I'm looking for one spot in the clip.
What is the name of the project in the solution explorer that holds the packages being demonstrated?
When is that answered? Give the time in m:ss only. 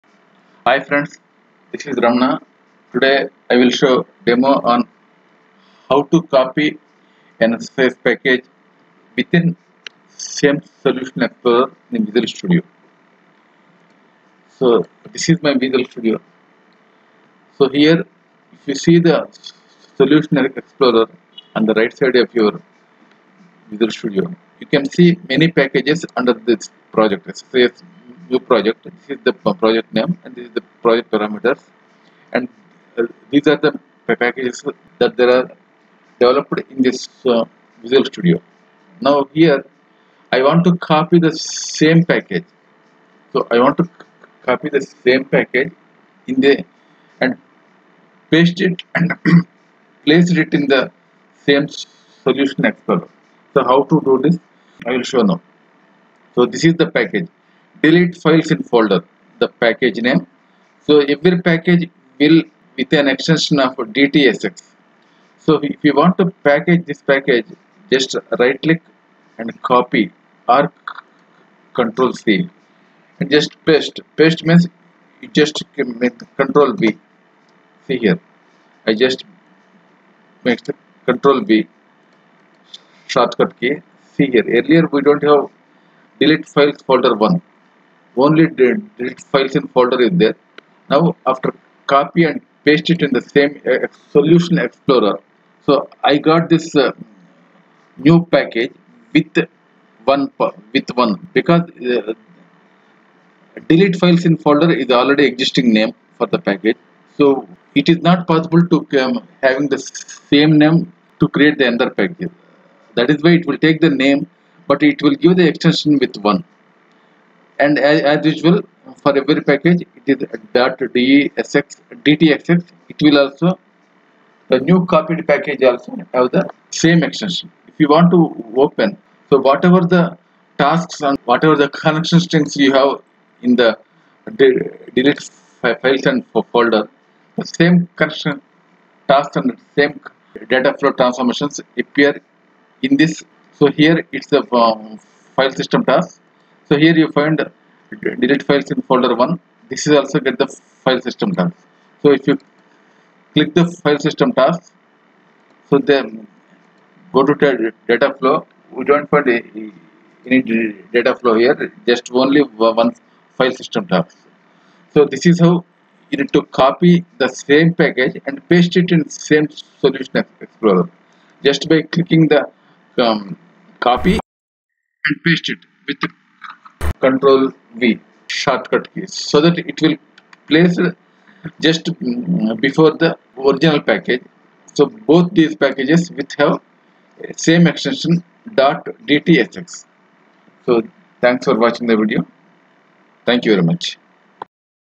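0:27.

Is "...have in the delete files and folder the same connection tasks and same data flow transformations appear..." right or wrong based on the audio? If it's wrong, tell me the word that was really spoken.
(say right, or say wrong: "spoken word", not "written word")
right.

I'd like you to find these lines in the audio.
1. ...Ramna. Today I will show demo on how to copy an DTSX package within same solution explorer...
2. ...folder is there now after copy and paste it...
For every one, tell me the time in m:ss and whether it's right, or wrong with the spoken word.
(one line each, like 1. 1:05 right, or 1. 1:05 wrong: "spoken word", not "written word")
1. 0:02 wrong: "SSIS", not "DTSX"
2. 1:29 right.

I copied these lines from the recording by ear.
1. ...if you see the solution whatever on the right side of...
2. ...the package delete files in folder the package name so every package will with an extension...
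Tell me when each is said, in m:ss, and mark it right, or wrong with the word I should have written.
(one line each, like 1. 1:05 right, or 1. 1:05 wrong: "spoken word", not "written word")
1. 0:18 wrong: "explorer", not "whatever"
2. 0:56 right.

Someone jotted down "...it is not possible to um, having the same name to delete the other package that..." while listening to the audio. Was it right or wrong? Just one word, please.
wrong.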